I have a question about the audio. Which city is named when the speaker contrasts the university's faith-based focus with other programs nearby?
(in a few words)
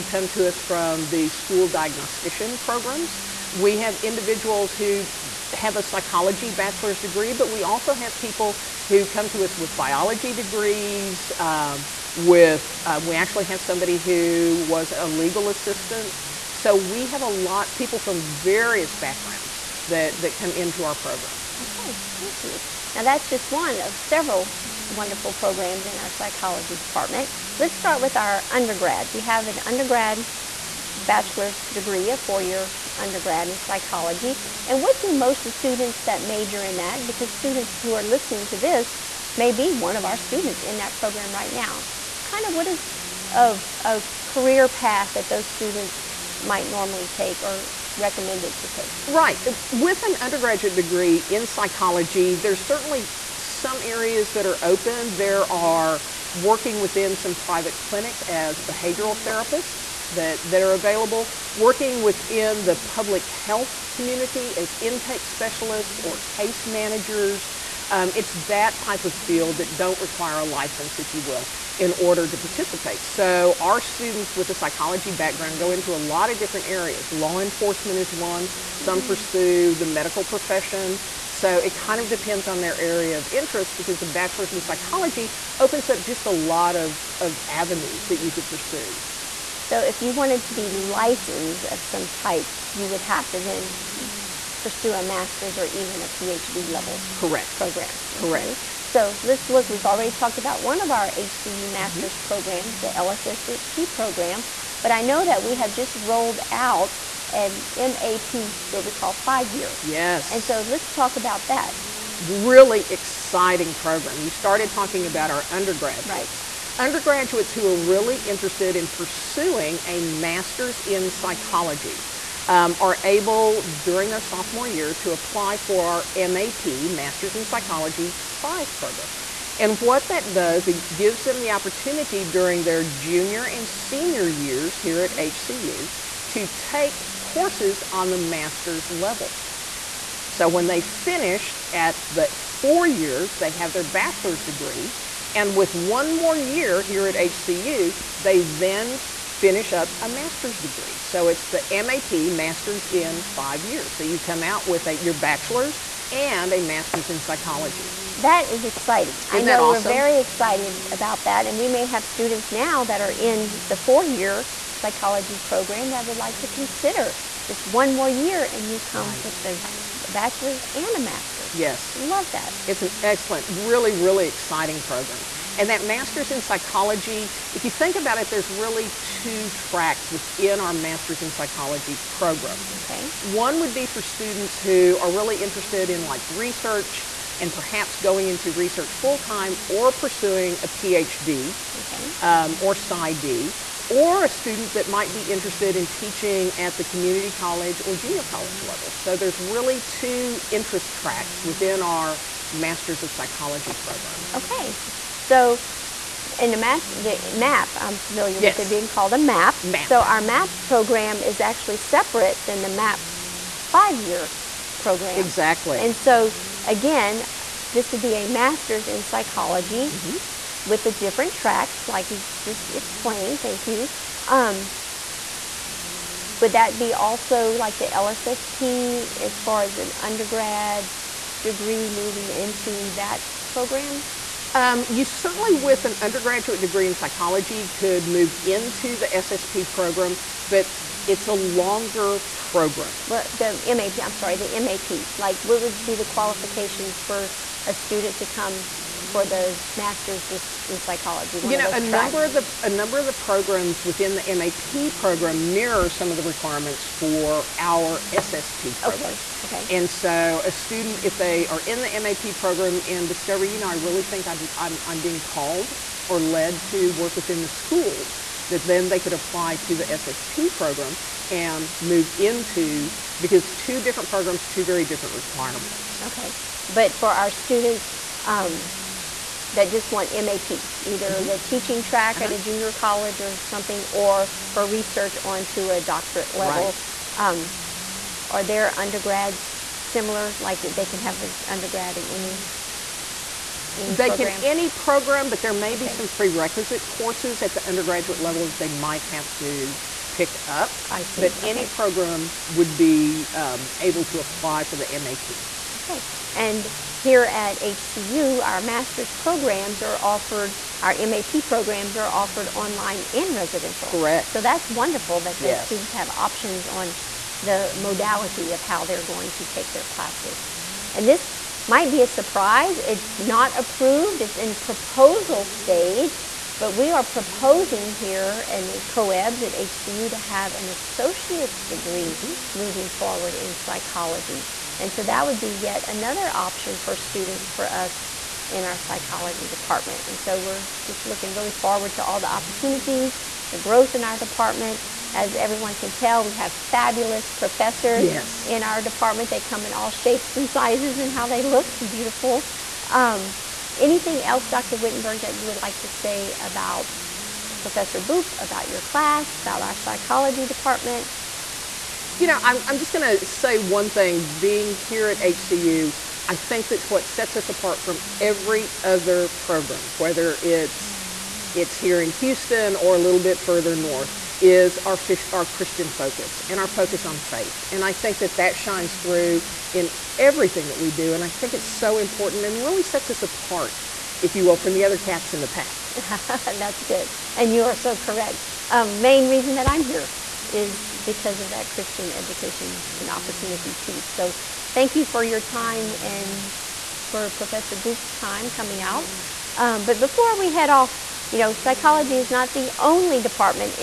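Houston.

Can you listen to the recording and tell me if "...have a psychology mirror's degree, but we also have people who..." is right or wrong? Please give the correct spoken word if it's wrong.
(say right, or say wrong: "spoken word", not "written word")
wrong: "bachelor", not "mirror".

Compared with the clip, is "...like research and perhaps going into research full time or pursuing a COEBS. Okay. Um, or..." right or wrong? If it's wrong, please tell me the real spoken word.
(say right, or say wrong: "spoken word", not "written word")
wrong: "PhD", not "COEBS".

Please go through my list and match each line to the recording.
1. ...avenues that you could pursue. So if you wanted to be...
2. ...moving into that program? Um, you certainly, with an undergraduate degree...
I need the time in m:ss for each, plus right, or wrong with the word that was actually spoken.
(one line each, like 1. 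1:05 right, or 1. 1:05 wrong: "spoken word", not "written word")
1. 1:27 right
2. 3:51 right.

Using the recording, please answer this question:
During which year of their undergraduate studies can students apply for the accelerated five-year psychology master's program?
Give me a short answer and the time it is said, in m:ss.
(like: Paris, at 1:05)
Sophomore year, at 2:04.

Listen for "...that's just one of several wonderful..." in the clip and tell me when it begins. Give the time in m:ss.
0:23.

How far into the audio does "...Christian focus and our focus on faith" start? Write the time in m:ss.
6:15.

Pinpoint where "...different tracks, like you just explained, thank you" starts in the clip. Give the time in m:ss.
3:40.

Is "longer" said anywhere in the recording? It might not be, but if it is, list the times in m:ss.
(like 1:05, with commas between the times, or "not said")
4:01.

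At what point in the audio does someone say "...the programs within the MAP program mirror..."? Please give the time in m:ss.
4:13.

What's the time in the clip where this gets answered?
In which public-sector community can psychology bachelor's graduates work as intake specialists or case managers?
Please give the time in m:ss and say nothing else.
1:02.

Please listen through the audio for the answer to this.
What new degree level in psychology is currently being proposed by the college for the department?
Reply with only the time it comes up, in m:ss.
5:30.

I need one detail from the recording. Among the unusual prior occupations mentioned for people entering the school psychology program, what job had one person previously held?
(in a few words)
Legal assistant.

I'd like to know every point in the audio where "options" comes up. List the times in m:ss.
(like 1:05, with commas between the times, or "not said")
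5:16, 5:36.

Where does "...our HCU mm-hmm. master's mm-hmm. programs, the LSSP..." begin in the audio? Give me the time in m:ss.
1:40.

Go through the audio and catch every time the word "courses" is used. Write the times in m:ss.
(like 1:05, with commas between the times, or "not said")
2:17, 4:56.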